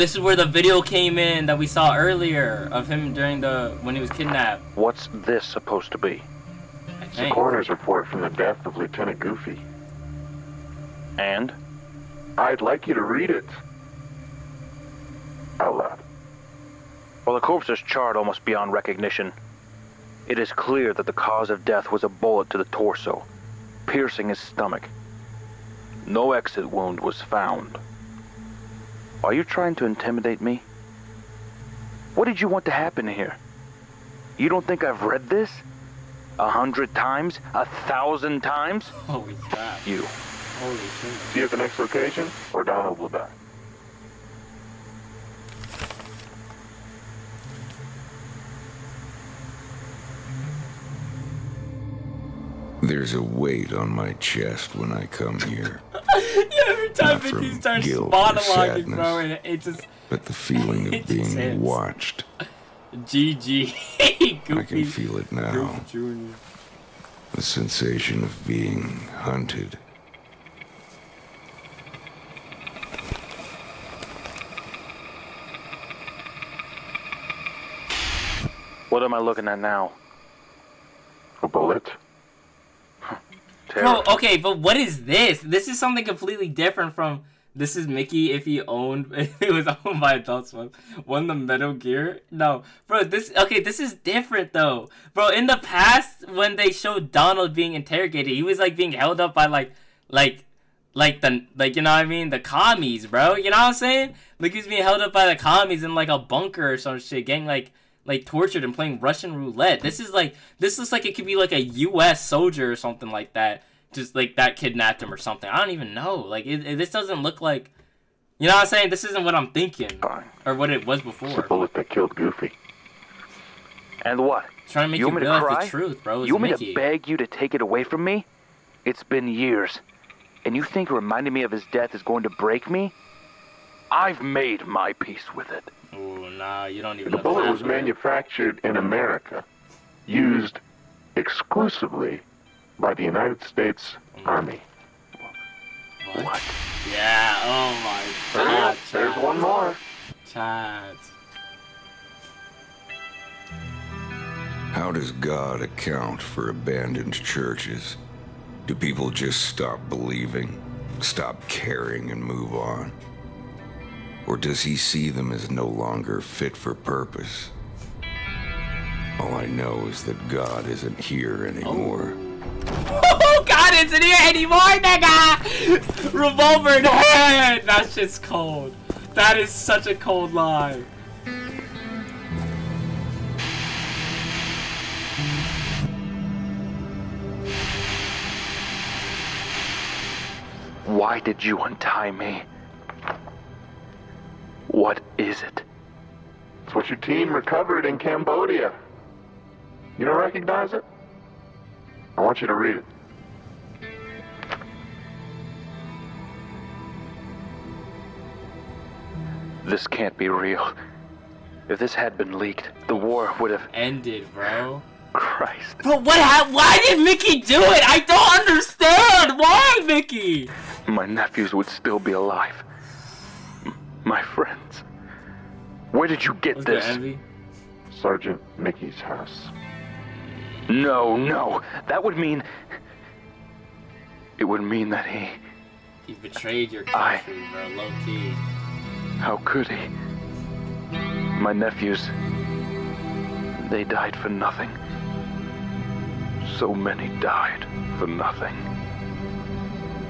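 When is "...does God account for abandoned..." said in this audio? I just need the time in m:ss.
2:34.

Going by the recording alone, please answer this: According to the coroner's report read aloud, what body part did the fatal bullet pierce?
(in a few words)
Stomach.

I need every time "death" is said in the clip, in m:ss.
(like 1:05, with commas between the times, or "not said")
0:08, 0:21, 2:11.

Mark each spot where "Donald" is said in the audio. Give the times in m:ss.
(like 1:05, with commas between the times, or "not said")
0:42, 1:37.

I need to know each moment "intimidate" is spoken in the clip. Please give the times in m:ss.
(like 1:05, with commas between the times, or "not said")
0:29.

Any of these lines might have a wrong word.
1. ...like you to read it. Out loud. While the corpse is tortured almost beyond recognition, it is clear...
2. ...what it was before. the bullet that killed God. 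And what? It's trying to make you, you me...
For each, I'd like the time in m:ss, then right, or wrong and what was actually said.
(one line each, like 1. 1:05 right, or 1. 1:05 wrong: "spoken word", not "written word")
1. 0:12 wrong: "charred", not "tortured"
2. 2:00 wrong: "Goofy", not "God".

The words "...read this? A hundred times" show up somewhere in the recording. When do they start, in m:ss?
0:35.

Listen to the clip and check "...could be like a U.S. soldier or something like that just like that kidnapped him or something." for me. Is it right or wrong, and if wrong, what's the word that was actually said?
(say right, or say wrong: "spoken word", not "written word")
right.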